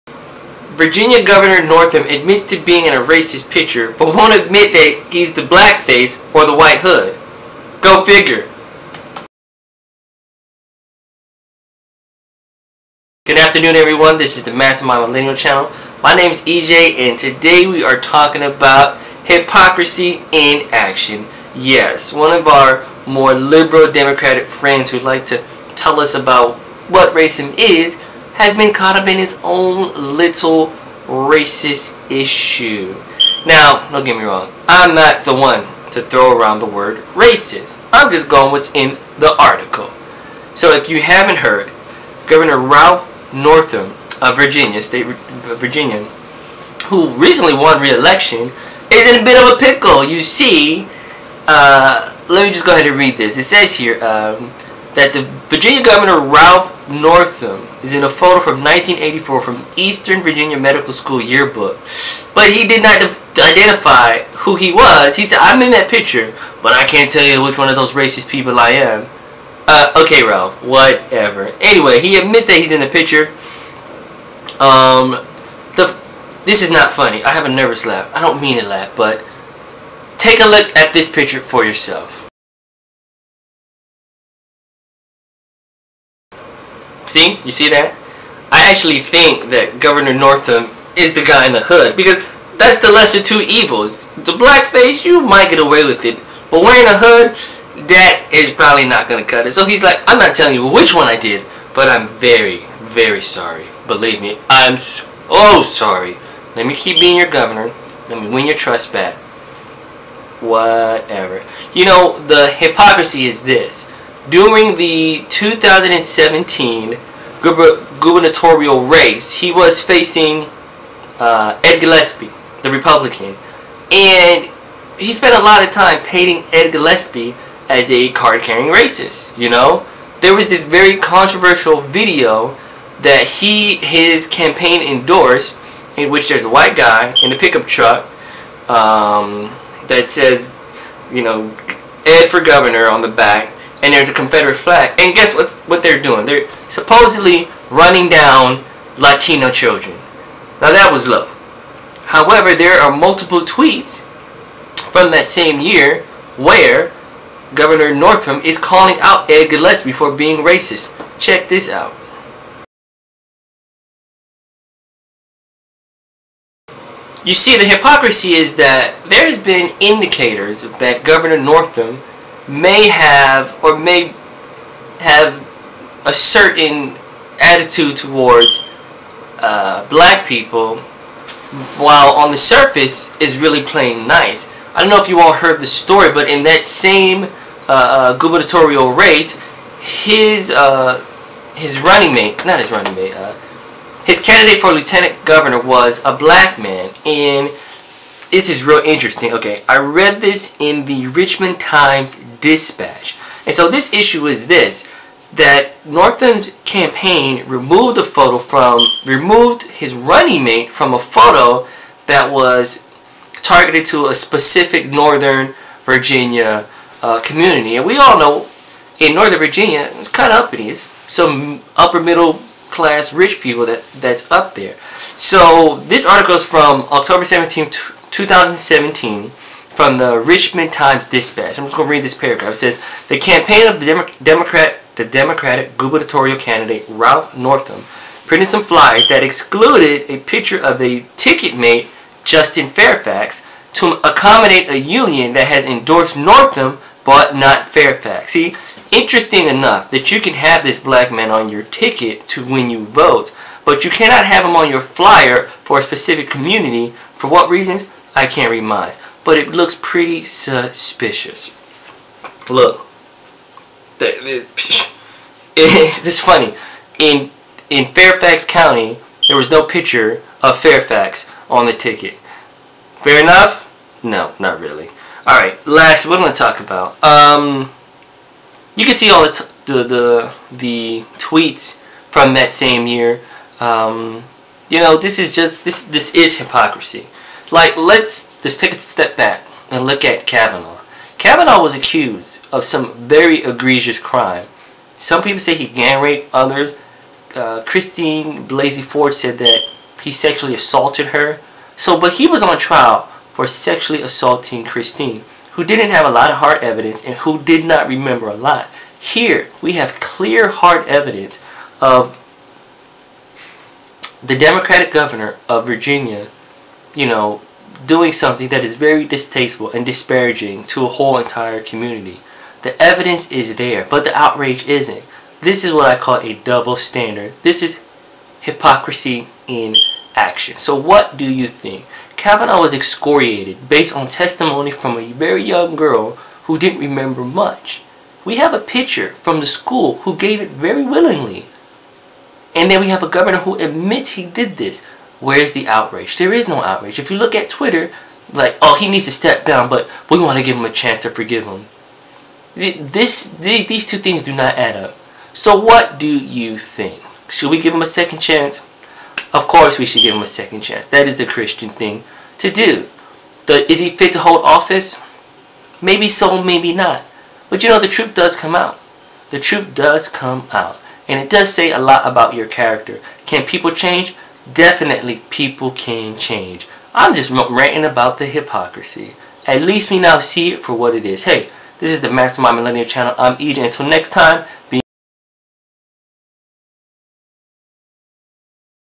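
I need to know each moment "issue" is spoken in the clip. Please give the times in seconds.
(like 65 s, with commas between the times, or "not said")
32 s, 203 s.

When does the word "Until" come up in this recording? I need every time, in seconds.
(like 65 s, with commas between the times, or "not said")
383 s.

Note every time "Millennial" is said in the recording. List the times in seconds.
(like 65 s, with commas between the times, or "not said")
15 s, 382 s.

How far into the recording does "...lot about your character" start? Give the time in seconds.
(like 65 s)
371 s.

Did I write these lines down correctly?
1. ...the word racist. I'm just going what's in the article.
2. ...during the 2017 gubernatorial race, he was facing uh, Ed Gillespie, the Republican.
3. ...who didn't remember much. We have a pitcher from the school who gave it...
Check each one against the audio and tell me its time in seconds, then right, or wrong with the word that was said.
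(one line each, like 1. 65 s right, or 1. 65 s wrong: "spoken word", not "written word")
1. 36 s right
2. 114 s right
3. 336 s right.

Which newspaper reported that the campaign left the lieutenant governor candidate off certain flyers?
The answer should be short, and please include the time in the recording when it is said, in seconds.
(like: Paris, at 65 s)
Richmond Times-Dispatch, at 201 s.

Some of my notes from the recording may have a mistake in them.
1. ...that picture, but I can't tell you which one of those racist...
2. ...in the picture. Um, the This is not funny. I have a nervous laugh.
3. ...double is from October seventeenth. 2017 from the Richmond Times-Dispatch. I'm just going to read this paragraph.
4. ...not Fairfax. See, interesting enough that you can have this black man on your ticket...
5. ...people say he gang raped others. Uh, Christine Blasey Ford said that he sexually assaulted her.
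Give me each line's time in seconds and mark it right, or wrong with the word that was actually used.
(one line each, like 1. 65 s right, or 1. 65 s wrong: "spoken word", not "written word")
1. 65 s right
2. 72 s right
3. 226 s wrong: "article", not "double"
4. 247 s right
5. 295 s right.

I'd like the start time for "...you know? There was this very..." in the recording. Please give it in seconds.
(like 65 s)
129 s.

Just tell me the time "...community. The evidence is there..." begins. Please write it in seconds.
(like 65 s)
321 s.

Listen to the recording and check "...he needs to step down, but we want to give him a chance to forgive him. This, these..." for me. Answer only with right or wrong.
right.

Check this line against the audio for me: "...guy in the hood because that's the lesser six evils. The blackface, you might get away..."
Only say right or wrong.
wrong.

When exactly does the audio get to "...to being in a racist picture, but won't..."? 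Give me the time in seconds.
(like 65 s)
2 s.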